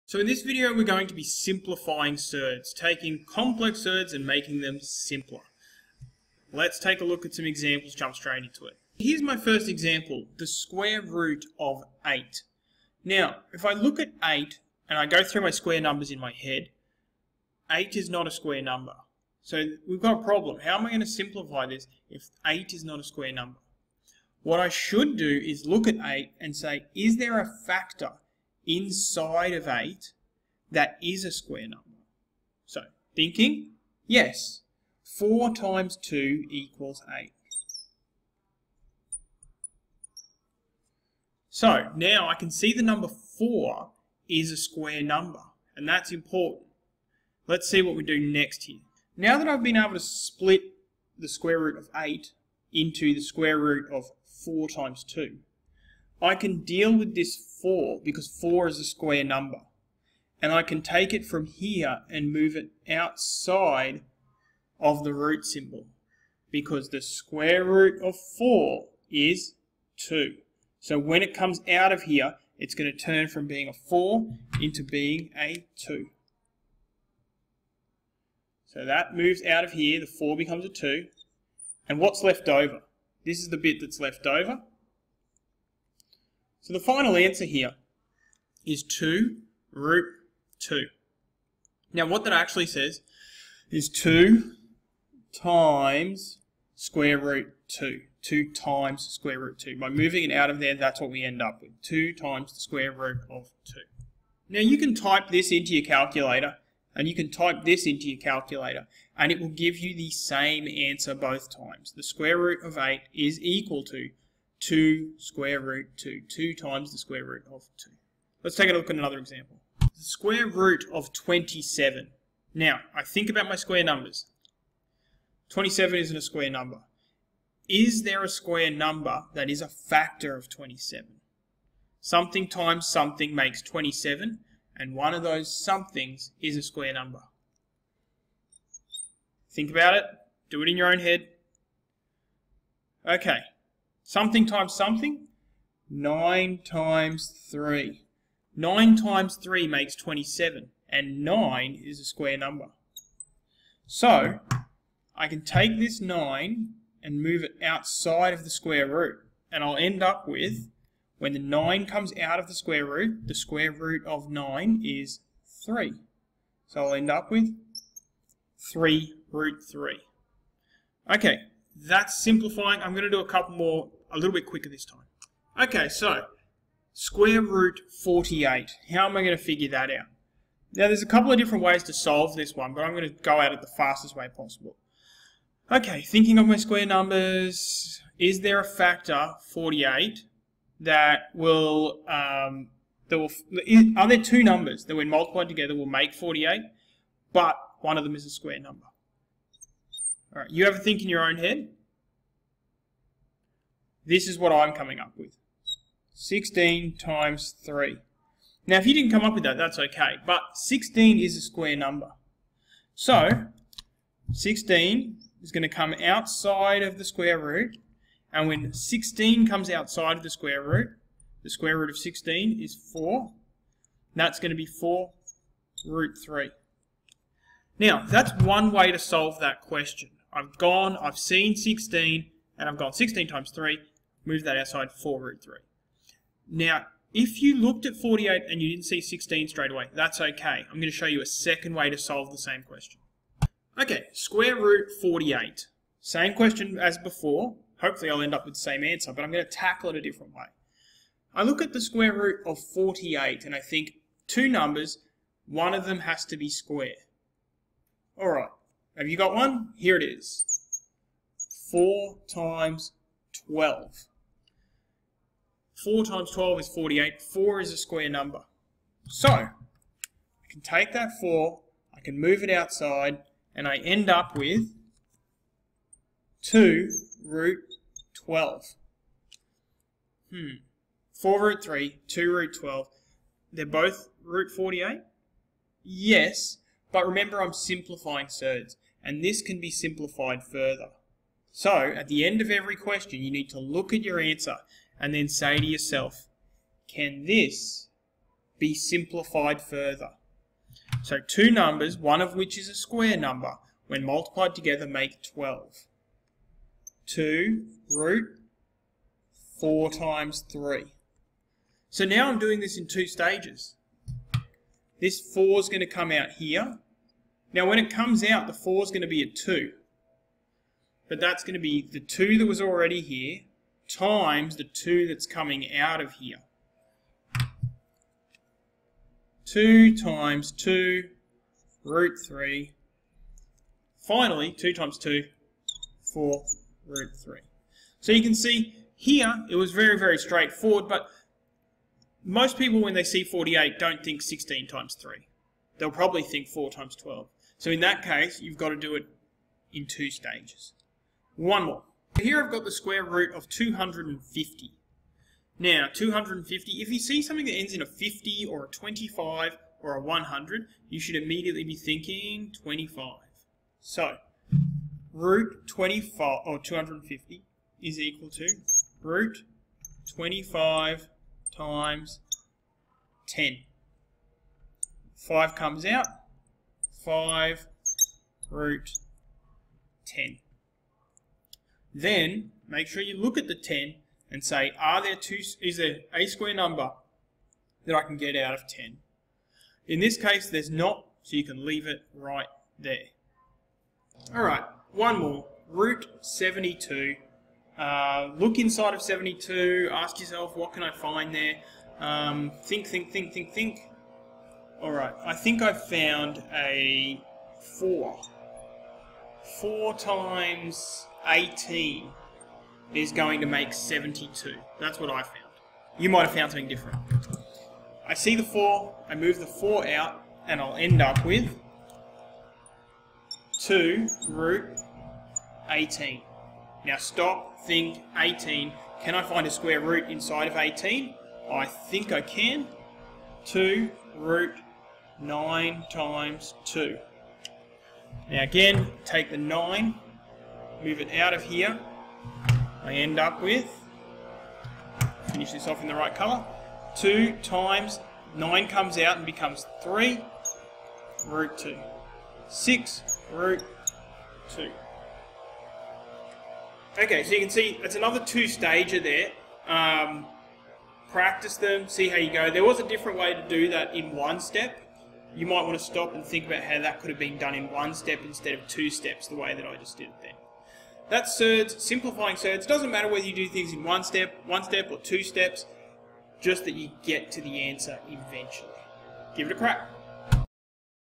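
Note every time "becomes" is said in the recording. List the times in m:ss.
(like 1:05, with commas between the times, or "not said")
1:20, 7:29.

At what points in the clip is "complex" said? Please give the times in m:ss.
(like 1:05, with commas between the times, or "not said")
0:03.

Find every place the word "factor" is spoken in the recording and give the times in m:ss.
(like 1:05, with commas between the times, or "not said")
0:27, 2:09, 3:08.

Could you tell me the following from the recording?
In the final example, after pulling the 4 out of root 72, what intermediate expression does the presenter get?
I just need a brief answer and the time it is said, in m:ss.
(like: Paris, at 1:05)
2 root 18, at 7:03.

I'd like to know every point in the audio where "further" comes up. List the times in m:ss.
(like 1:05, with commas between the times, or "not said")
4:50, 4:59.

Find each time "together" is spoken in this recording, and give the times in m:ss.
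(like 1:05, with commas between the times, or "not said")
3:15, 5:04.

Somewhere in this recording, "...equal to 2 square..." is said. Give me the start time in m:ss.
1:53.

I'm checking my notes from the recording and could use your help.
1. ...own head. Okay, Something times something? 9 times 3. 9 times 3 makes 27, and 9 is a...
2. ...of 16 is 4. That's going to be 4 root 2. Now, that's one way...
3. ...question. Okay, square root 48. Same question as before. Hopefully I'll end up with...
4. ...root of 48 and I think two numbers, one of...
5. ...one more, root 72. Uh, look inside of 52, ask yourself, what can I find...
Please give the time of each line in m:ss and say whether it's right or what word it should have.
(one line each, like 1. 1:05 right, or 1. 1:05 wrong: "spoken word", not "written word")
1. 2:20 right
2. 3:41 wrong: "3", not "2"
3. 4:02 right
4. 4:12 right
5. 6:34 wrong: "72", not "52".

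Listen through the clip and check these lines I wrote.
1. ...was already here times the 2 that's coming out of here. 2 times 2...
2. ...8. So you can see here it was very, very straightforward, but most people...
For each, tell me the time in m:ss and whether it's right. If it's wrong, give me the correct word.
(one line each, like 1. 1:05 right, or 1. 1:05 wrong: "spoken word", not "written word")
1. 5:22 right
2. 5:37 wrong: "3", not "8".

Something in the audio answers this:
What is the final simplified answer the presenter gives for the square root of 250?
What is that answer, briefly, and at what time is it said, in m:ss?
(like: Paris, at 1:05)
5 root 10, at 6:17.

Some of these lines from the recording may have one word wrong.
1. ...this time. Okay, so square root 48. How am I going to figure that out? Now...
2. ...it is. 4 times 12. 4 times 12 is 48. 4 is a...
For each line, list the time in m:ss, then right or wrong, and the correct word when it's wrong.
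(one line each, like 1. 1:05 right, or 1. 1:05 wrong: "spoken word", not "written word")
1. 2:54 right
2. 4:19 right.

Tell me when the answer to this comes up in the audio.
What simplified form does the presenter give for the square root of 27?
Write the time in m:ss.
2:48.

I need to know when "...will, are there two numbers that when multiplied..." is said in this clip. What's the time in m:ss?
3:13.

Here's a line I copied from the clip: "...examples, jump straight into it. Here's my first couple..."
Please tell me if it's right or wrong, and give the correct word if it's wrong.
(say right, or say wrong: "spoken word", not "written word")
wrong: "example", not "couple".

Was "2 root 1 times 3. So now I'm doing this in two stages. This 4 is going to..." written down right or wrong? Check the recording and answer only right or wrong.
wrong.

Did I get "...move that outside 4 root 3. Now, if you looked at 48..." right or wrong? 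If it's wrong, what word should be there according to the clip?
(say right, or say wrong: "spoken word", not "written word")
right.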